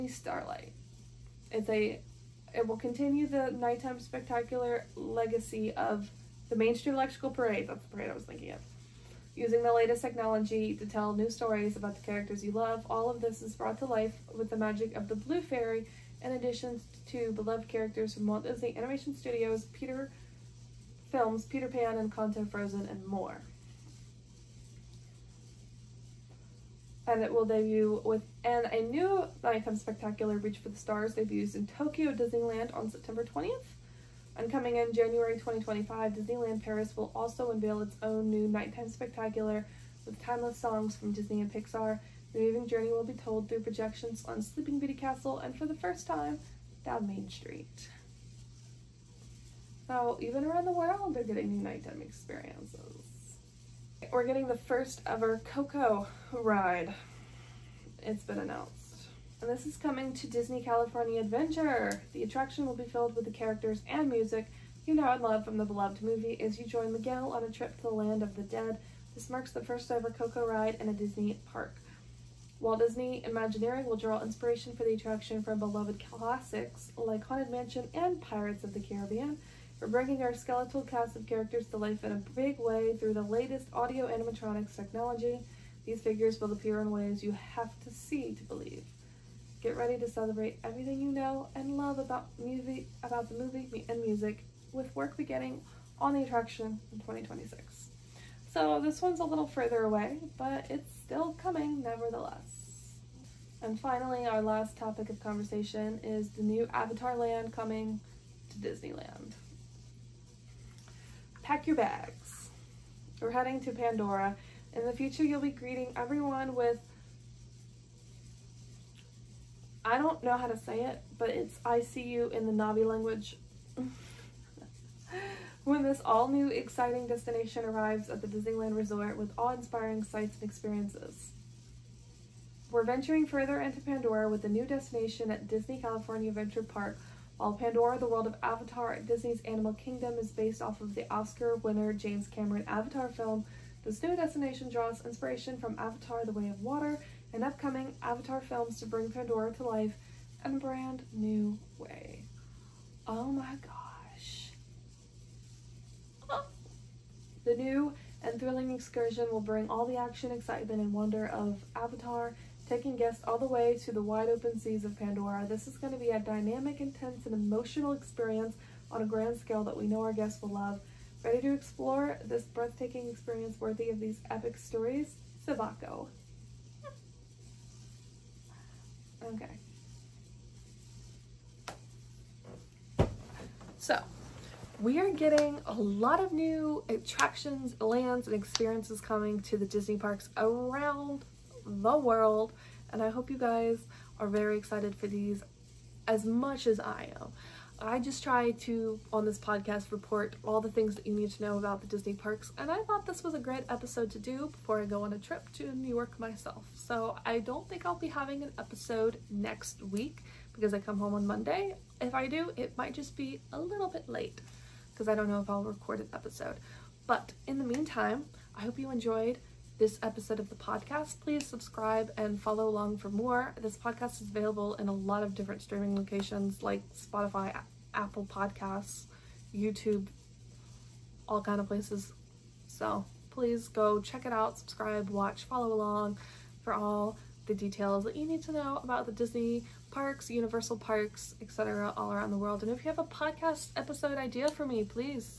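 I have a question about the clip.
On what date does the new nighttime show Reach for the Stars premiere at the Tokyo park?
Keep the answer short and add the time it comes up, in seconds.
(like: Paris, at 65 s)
September 20th, at 32 s.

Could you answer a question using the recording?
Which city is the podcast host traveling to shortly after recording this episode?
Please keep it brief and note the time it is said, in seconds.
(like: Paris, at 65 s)
New York, at 205 s.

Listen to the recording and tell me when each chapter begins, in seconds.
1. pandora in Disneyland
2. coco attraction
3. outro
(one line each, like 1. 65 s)
1. 103 s
2. 54 s
3. 186 s.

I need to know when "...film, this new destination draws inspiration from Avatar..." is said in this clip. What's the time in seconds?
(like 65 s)
143 s.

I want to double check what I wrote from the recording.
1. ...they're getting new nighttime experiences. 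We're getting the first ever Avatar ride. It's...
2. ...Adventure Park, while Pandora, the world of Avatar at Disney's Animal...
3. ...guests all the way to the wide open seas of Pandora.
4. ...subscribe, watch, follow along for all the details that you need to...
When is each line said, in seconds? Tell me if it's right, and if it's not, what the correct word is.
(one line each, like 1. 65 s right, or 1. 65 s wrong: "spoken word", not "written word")
1. 51 s wrong: "Coco", not "Avatar"
2. 136 s right
3. 162 s right
4. 234 s right.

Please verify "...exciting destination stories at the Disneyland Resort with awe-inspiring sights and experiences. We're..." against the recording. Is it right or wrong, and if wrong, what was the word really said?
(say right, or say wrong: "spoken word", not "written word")
wrong: "arrives", not "stories".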